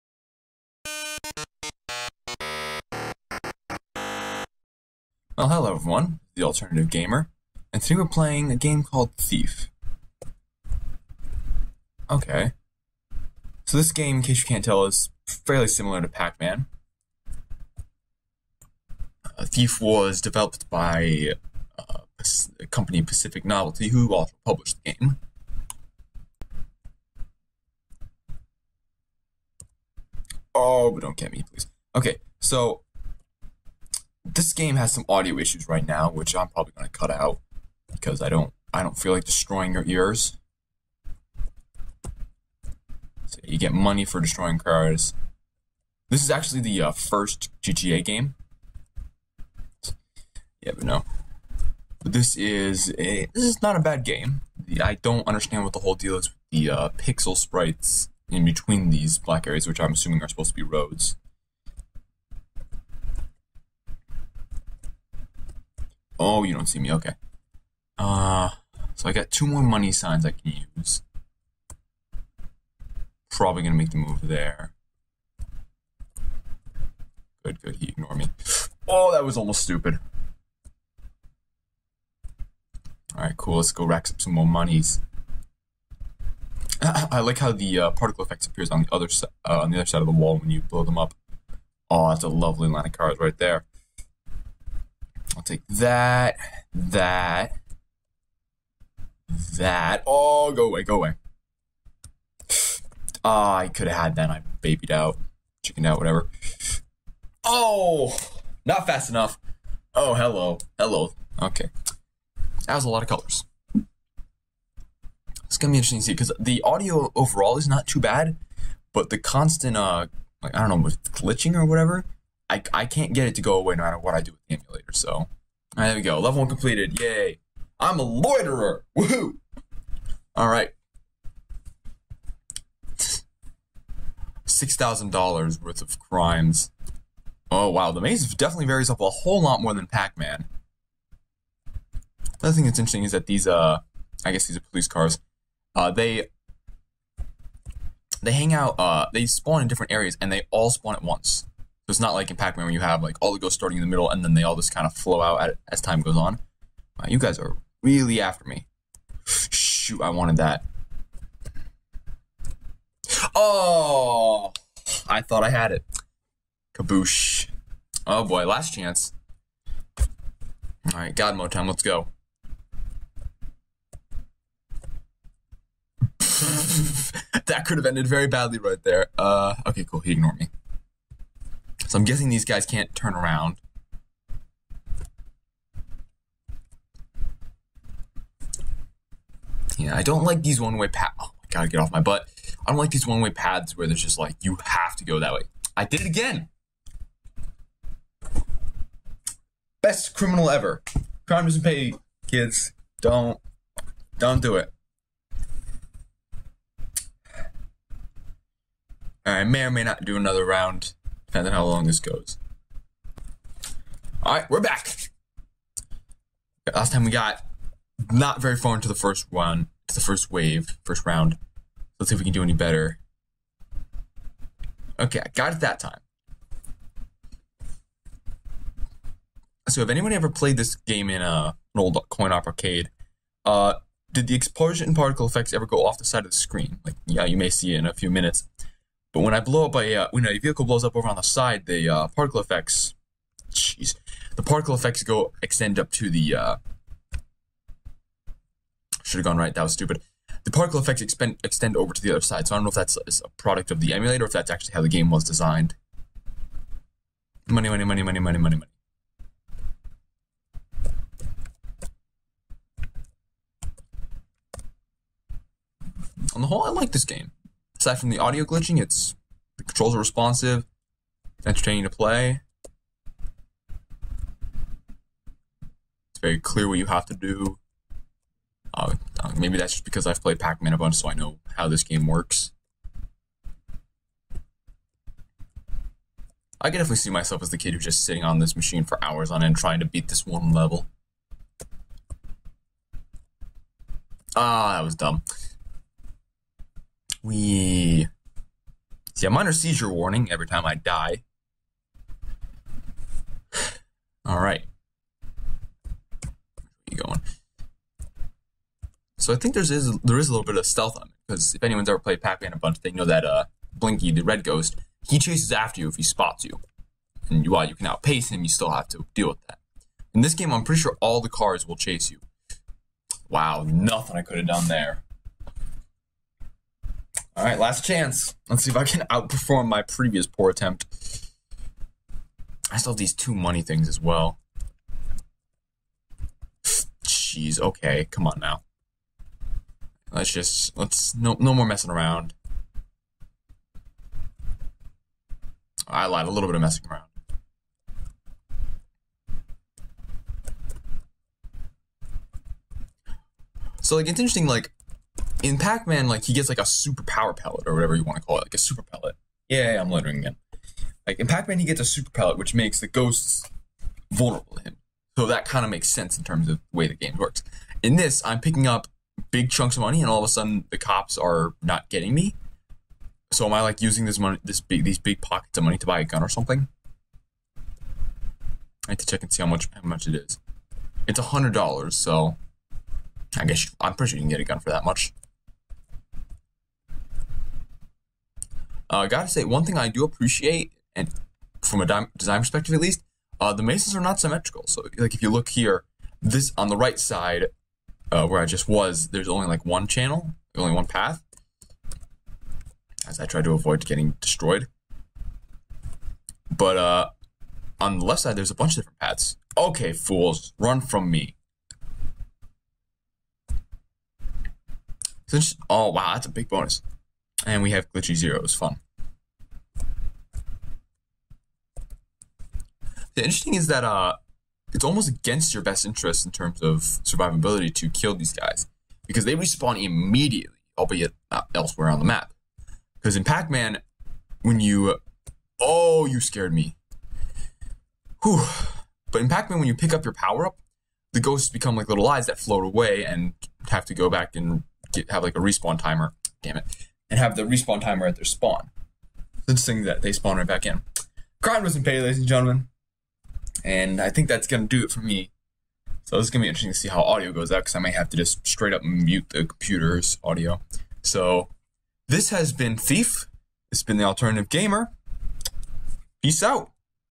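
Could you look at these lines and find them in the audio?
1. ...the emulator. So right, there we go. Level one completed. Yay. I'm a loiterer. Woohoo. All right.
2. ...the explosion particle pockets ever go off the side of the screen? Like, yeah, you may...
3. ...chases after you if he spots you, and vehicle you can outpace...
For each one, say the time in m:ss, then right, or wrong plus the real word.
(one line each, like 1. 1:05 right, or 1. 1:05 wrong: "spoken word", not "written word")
1. 2:04 right
2. 3:54 wrong: "effects", not "pockets"
3. 5:15 wrong: "while", not "vehicle".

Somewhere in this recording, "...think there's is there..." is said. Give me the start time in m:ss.
5:09.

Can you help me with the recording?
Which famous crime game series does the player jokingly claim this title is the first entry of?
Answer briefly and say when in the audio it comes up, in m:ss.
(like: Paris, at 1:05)
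GTA, at 0:47.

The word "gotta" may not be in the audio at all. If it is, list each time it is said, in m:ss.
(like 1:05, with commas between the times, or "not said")
3:11, 6:29.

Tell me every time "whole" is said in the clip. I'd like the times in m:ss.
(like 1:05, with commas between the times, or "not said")
0:55, 2:19, 4:26.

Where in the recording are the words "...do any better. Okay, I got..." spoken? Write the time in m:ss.
3:42.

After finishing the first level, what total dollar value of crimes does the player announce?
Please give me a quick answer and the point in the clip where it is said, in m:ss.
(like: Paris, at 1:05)
$6,000, at 2:14.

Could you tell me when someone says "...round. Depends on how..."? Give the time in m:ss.
3:30.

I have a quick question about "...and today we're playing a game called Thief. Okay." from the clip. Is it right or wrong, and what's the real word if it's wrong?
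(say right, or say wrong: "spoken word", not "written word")
right.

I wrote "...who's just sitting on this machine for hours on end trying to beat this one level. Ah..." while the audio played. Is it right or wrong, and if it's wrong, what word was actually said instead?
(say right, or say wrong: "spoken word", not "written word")
right.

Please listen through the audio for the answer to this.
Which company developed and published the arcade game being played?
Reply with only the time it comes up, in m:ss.
0:23.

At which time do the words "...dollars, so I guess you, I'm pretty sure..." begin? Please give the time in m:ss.
6:21.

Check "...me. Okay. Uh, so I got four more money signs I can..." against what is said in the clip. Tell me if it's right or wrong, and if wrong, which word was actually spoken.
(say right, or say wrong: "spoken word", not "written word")
wrong: "two", not "four".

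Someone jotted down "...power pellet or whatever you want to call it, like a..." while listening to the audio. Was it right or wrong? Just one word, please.
right.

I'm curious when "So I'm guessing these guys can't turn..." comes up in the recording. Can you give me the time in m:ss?
3:01.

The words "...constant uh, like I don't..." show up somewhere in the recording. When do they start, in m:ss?
1:59.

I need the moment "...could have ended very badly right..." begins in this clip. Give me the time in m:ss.
2:57.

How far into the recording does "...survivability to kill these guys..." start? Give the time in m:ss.
7:06.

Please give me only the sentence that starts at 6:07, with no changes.
In this, I'm picking up big chunks of money, and all of a sudden the cops are not getting me.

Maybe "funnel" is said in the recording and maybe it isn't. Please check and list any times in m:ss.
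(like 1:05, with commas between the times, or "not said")
not said.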